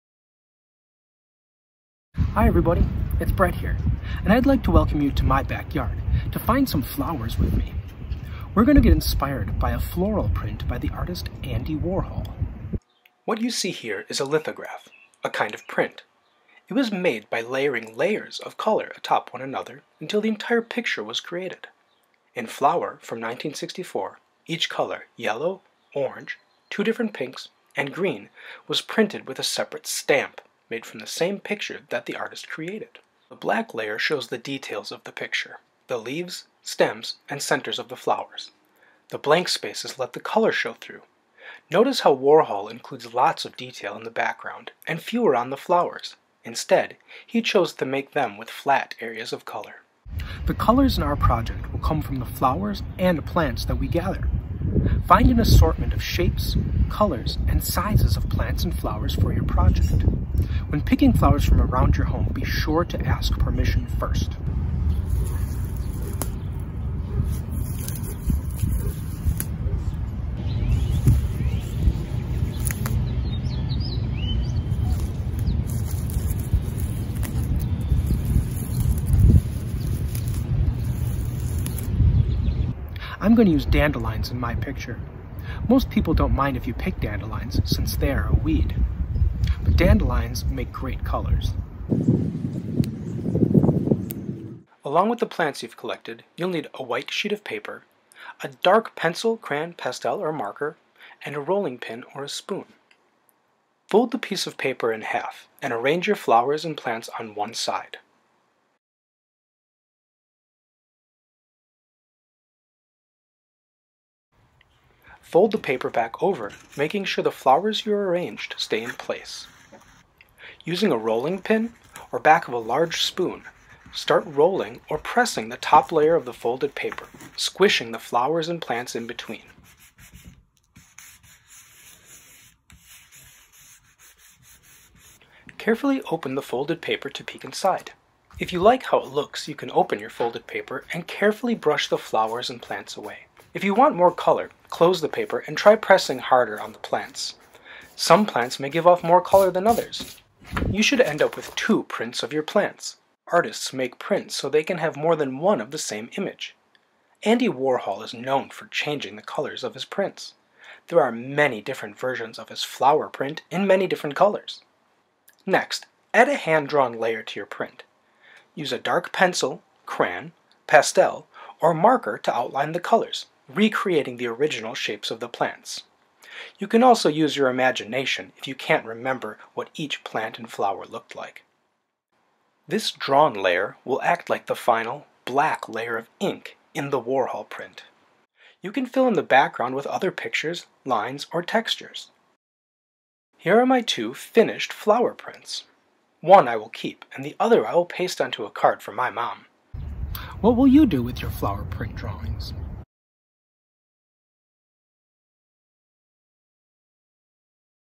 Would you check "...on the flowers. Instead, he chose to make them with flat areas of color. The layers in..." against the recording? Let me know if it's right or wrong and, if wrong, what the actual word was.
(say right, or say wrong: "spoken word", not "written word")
wrong: "colors", not "layers".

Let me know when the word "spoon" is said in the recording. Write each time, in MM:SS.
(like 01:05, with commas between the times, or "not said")
01:42, 02:03.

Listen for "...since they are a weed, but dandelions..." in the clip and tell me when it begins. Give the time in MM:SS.
01:27.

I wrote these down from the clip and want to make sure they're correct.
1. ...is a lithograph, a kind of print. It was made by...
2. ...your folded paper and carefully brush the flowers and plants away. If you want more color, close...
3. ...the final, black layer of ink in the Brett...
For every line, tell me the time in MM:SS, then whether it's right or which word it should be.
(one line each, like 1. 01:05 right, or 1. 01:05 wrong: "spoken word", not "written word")
1. 00:14 right
2. 02:19 right
3. 03:04 wrong: "Warhol", not "Brett".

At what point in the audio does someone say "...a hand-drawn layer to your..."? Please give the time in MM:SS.
02:46.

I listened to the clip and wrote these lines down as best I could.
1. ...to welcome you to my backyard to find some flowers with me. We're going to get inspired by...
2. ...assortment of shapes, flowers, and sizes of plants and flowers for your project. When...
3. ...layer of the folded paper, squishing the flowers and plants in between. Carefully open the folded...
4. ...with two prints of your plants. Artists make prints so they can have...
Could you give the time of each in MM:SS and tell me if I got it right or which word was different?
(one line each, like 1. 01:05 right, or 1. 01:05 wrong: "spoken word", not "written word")
1. 00:04 right
2. 00:55 wrong: "colors", not "flowers"
3. 02:05 right
4. 02:31 right.